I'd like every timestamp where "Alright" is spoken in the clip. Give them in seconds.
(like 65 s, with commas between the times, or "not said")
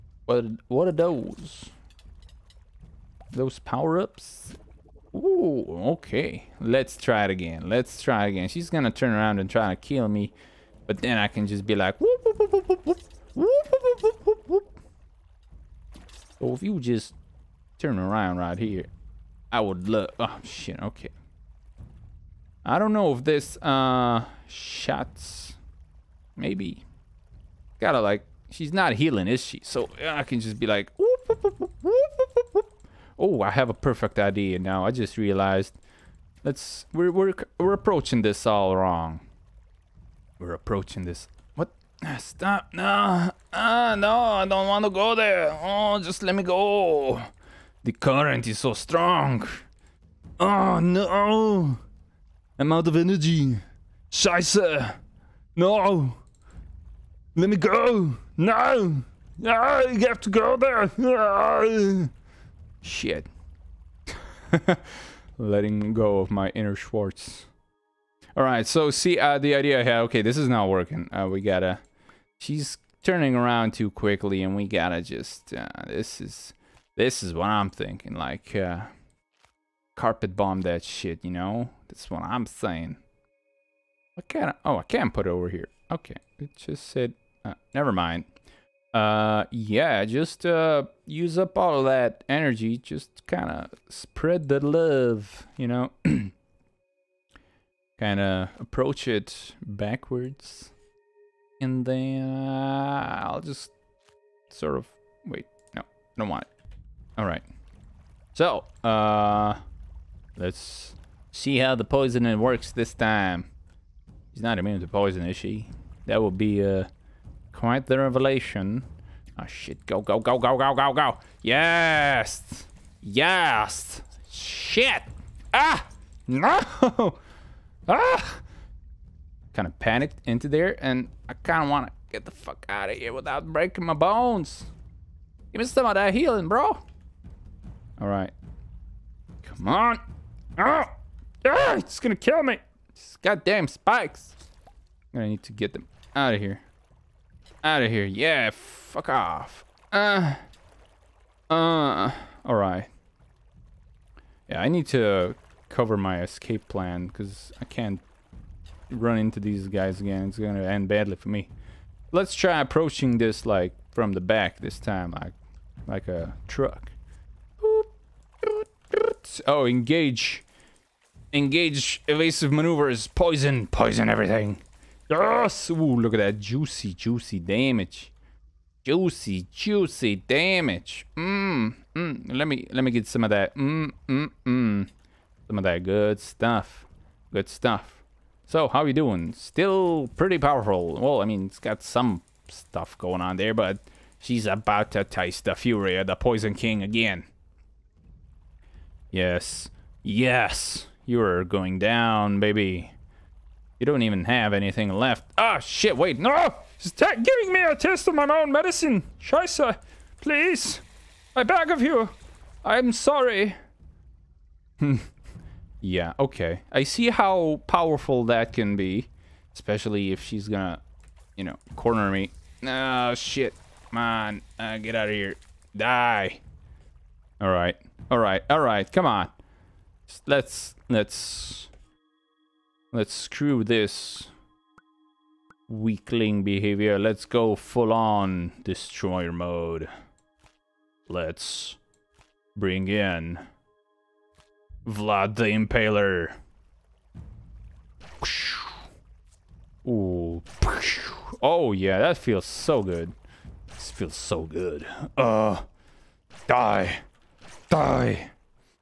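68 s, 152 s.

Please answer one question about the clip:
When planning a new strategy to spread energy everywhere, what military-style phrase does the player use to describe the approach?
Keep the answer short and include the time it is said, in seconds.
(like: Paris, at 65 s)
Carpet bomb, at 79 s.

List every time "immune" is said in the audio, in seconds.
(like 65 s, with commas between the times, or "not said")
114 s.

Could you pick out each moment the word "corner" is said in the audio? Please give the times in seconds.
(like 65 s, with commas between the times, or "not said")
221 s.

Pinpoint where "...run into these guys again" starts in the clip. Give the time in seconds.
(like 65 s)
158 s.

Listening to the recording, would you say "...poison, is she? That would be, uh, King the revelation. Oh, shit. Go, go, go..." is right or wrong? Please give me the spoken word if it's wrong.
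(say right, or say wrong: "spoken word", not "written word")
wrong: "Quite", not "King".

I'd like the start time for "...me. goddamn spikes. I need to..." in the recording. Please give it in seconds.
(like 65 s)
142 s.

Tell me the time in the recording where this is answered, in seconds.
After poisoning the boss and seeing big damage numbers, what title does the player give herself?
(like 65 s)
196 s.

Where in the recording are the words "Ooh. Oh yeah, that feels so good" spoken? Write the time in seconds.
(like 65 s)
249 s.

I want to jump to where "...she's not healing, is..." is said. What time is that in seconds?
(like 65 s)
28 s.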